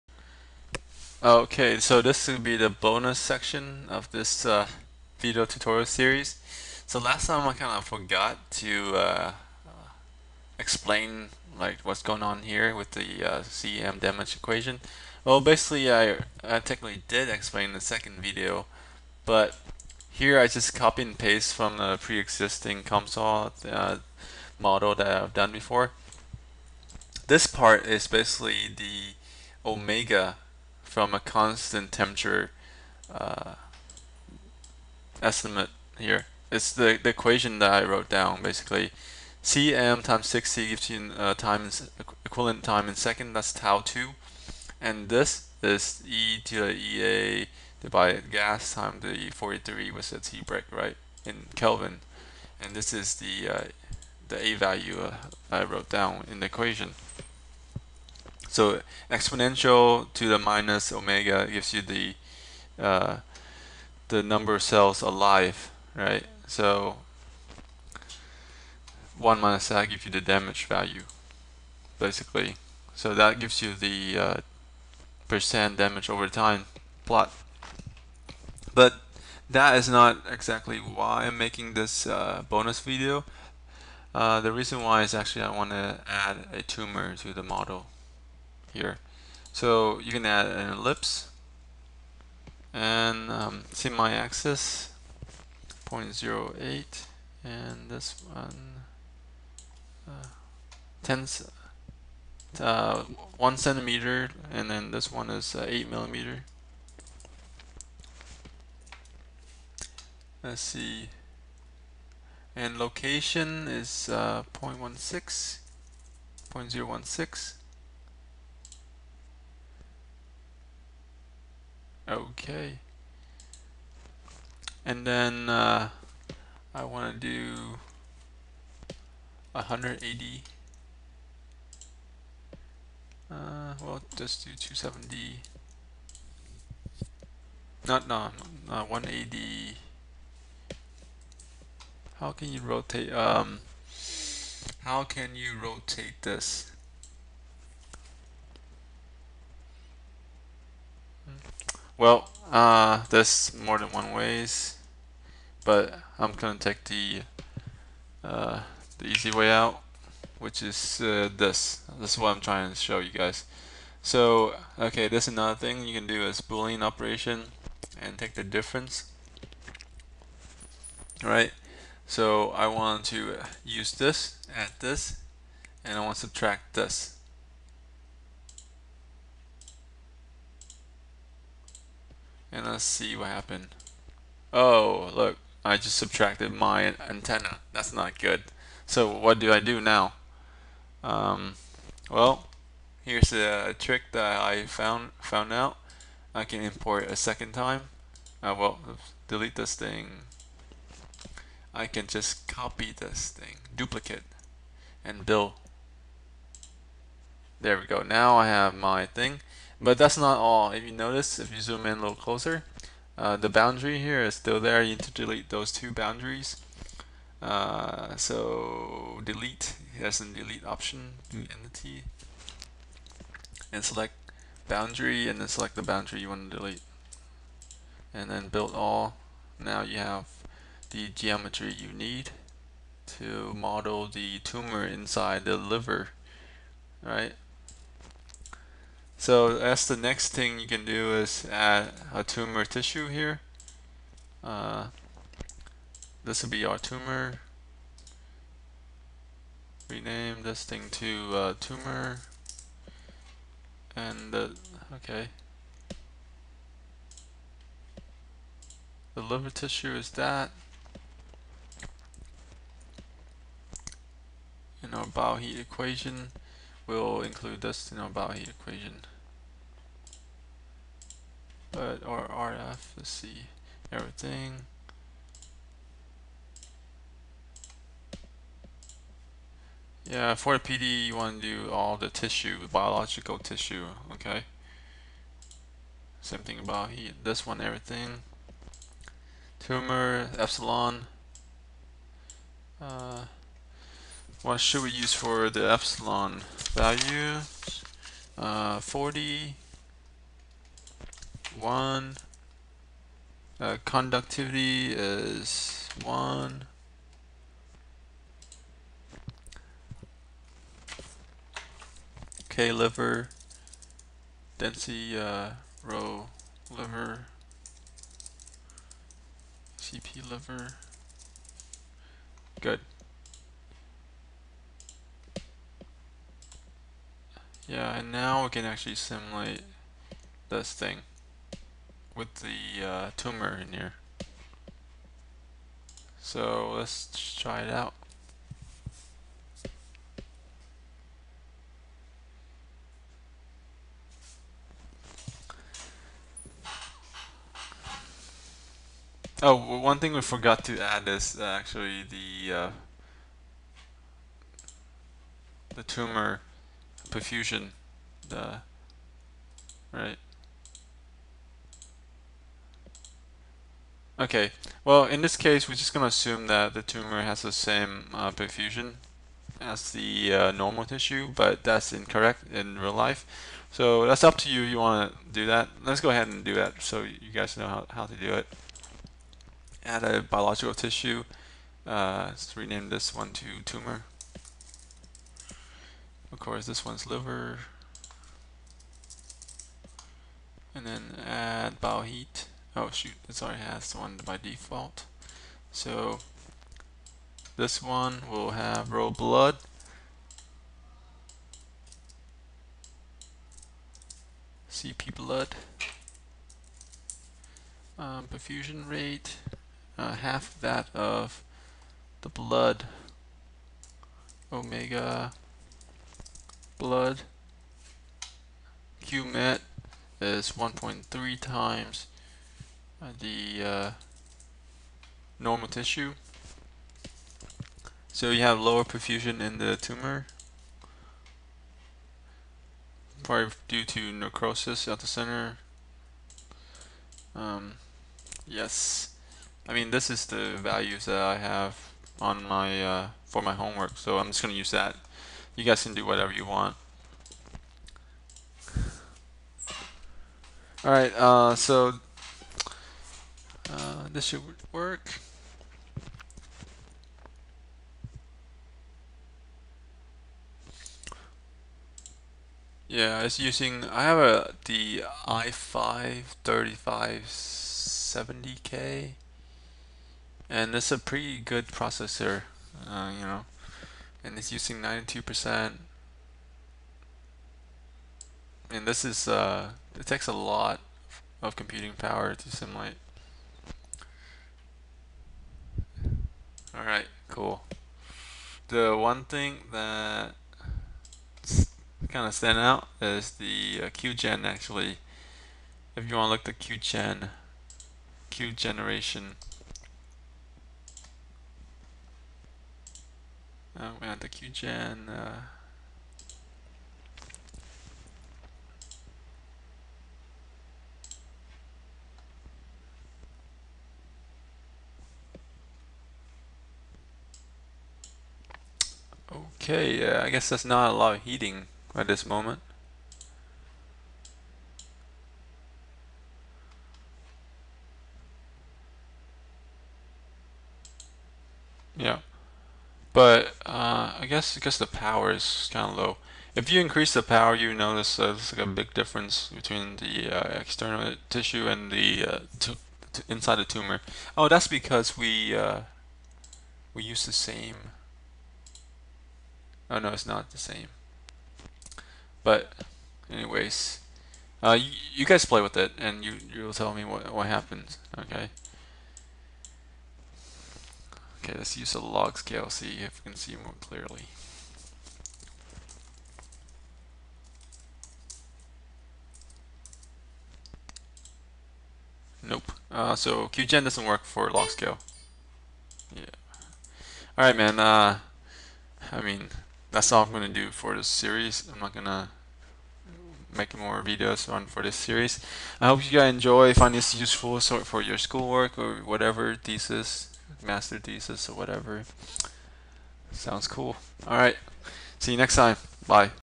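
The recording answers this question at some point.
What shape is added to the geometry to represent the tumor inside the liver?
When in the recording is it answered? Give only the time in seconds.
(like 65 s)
90 s.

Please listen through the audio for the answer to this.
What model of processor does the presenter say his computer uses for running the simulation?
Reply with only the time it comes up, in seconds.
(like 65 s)
465 s.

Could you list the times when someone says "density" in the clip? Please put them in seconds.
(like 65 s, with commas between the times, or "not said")
314 s.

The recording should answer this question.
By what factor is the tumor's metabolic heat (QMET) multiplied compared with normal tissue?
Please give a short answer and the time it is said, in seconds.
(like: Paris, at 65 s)
1.3, at 420 s.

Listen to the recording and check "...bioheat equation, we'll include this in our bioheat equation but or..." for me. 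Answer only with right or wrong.
right.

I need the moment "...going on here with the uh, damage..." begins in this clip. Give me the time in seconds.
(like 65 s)
12 s.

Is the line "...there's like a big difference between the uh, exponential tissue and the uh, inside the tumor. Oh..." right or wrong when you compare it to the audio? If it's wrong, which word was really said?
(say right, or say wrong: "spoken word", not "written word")
wrong: "external", not "exponential".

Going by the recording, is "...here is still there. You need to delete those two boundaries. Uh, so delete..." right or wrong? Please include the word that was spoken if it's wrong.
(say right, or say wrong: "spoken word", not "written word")
right.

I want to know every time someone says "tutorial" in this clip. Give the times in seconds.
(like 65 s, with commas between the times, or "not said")
5 s.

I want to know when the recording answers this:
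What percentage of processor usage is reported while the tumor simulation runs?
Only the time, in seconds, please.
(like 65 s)
474 s.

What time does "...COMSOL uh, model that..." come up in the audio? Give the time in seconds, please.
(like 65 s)
22 s.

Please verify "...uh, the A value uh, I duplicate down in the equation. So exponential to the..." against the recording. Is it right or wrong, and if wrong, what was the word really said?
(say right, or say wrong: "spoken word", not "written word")
wrong: "wrote", not "duplicate".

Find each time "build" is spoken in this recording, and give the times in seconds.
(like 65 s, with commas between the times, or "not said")
205 s, 228 s.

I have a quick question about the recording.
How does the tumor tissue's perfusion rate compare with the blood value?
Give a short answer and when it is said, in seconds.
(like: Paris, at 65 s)
Half, at 410 s.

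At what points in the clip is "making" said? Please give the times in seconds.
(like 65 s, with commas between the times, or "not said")
81 s.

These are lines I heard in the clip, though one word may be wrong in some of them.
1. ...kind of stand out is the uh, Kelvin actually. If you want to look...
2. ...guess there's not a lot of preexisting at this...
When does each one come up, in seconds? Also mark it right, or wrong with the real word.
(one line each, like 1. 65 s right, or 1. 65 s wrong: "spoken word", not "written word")
1. 492 s wrong: "QGen", not "Kelvin"
2. 520 s wrong: "heating", not "preexisting".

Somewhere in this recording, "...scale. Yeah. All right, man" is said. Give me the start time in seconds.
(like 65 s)
574 s.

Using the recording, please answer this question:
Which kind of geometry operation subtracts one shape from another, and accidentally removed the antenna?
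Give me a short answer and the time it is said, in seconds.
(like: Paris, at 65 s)
Boolean operation, at 166 s.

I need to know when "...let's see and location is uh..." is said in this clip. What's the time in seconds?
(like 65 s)
110 s.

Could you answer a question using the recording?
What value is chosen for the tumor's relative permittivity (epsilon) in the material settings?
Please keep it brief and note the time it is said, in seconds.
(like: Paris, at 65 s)
40, at 298 s.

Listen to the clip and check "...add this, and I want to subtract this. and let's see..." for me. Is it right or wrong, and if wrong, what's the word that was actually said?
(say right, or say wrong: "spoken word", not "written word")
right.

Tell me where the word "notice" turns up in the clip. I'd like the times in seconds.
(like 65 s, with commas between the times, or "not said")
210 s, 537 s.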